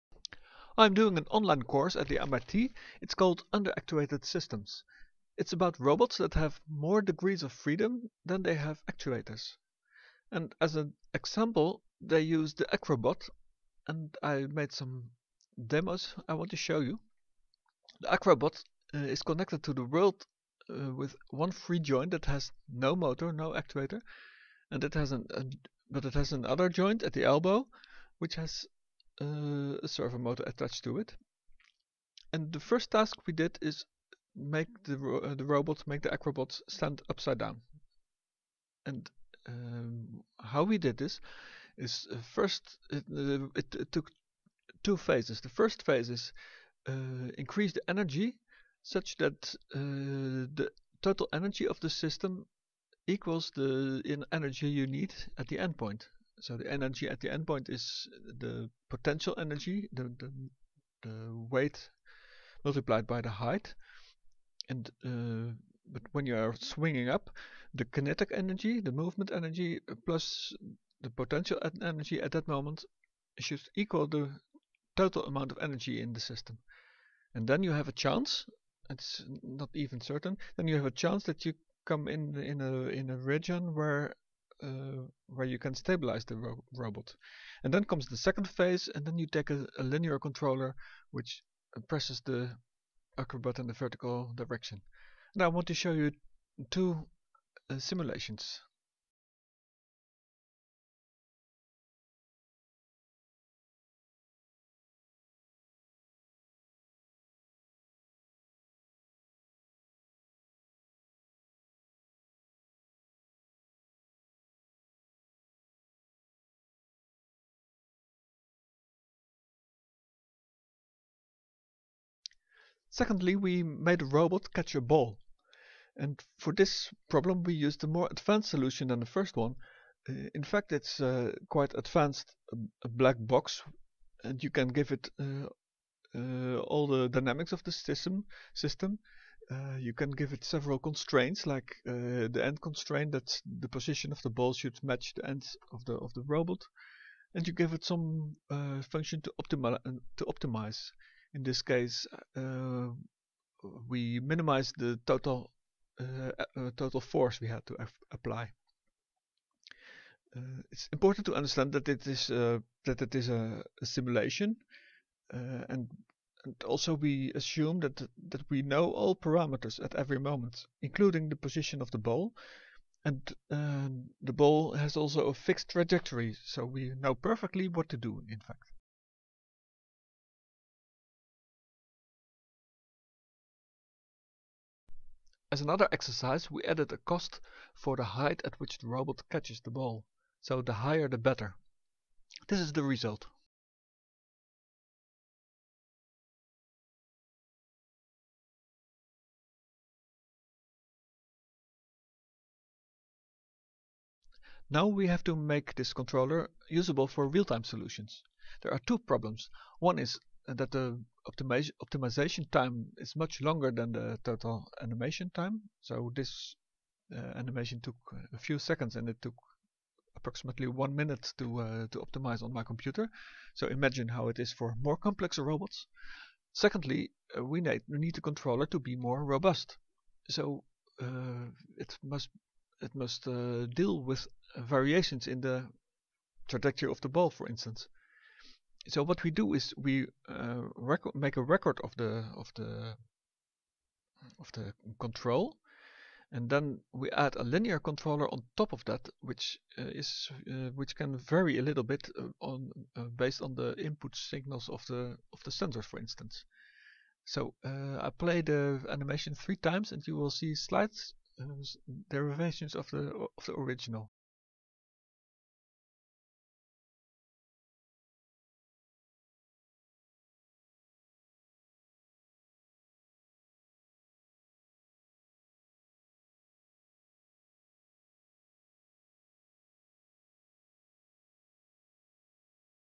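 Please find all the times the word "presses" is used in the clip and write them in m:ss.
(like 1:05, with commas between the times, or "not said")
1:31.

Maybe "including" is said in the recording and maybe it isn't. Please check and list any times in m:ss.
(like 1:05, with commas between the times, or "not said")
2:50.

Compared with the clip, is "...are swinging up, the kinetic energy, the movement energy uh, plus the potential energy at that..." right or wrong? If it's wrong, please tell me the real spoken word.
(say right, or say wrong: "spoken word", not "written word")
right.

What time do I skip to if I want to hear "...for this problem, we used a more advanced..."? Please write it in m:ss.
2:06.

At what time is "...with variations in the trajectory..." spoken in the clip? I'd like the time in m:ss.
3:54.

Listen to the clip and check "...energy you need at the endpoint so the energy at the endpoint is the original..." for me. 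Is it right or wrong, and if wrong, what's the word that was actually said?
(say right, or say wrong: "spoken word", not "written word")
wrong: "potential", not "original".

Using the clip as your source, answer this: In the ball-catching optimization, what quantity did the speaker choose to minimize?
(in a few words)
total force.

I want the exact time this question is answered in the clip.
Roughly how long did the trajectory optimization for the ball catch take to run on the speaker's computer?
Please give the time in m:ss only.
3:40.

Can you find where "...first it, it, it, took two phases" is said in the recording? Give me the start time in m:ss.
0:42.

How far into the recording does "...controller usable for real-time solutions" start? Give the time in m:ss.
3:25.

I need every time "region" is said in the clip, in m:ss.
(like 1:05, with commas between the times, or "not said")
1:23.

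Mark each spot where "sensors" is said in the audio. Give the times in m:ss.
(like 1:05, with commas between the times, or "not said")
4:15.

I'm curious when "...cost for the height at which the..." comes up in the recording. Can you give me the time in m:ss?
3:06.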